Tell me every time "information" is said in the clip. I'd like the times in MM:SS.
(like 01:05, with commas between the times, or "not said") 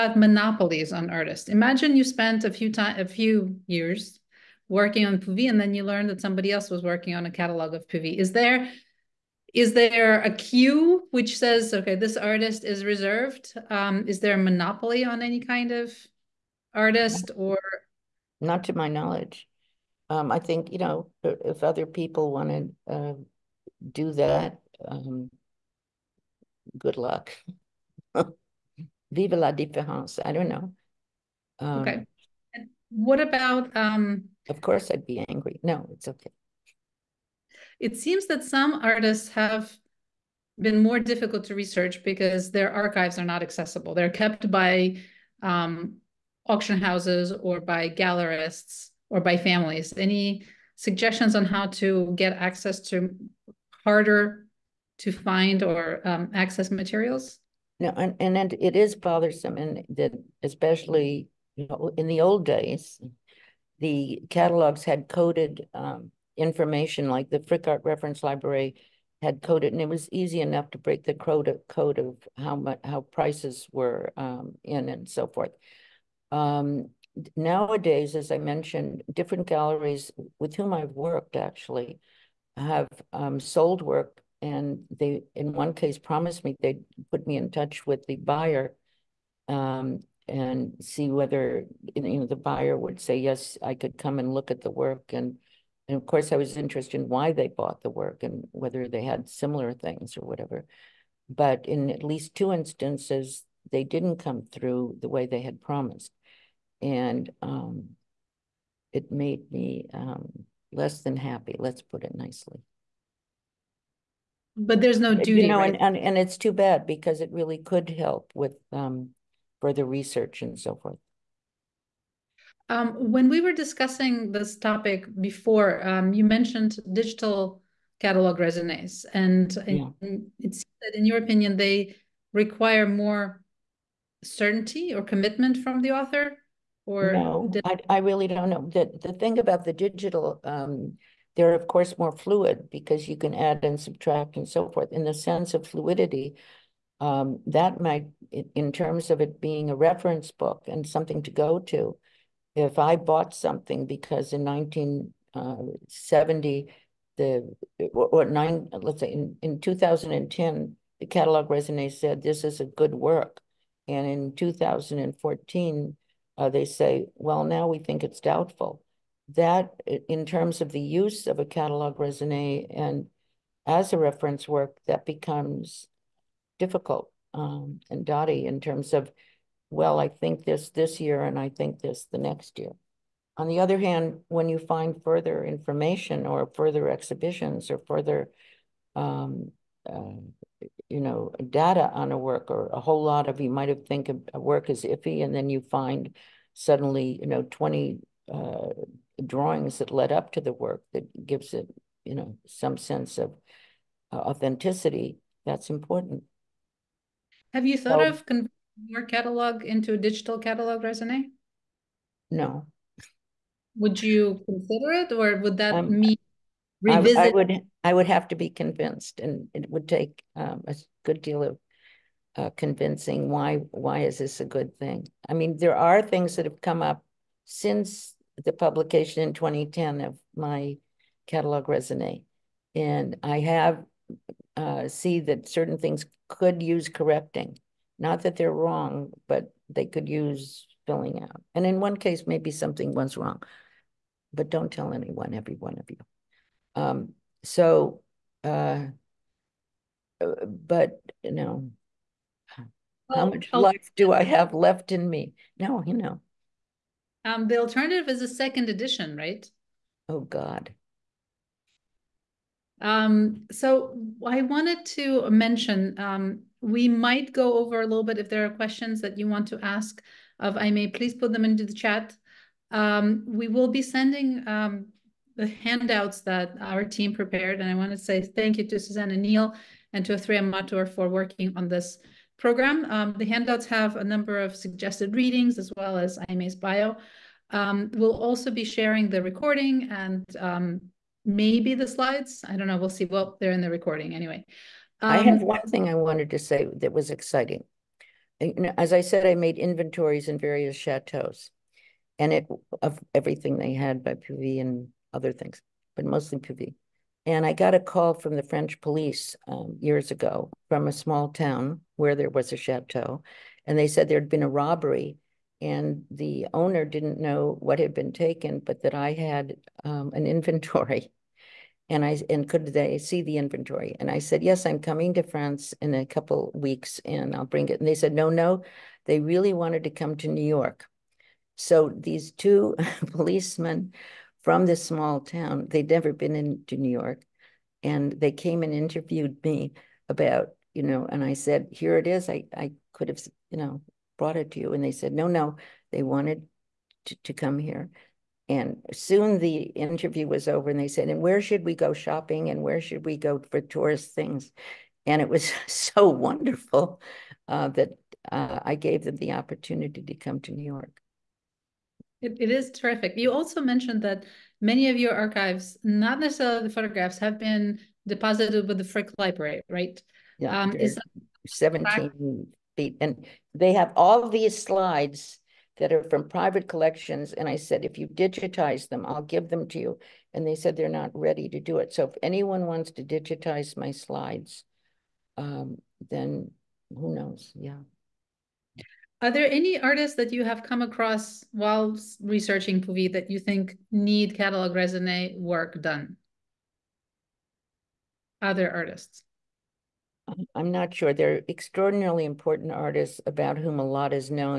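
01:06, 03:05.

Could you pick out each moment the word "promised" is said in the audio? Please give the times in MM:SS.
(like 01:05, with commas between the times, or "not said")
01:25, 01:45.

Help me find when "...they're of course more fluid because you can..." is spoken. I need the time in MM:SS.
02:21.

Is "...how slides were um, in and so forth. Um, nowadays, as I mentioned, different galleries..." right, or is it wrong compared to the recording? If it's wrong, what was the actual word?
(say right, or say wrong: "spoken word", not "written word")
wrong: "prices", not "slides".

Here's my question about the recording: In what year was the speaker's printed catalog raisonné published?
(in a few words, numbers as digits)
2010.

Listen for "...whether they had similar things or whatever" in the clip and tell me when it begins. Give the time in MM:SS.
01:38.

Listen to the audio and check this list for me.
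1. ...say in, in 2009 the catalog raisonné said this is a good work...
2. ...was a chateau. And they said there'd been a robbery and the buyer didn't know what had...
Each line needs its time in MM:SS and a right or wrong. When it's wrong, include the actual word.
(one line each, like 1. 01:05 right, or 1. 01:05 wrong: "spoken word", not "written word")
1. 02:39 wrong: "2010", not "2009"
2. 05:12 wrong: "owner", not "buyer".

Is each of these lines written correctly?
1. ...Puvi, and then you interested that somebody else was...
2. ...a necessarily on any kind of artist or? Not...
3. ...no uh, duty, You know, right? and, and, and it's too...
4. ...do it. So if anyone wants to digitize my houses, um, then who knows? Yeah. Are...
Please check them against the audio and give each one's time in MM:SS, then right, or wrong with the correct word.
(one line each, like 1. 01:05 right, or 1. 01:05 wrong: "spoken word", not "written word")
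1. 00:05 wrong: "learned", not "interested"
2. 00:14 wrong: "monopoly", not "necessarily"
3. 01:54 right
4. 06:21 wrong: "slides", not "houses".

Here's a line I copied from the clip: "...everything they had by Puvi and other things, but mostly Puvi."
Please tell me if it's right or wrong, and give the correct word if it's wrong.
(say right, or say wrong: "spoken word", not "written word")
right.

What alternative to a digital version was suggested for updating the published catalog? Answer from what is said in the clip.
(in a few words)
A second edition.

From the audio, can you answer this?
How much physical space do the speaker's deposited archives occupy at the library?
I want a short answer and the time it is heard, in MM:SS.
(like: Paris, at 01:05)
17 feet, at 06:11.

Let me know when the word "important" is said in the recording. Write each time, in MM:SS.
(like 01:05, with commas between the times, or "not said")
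03:25, 06:42.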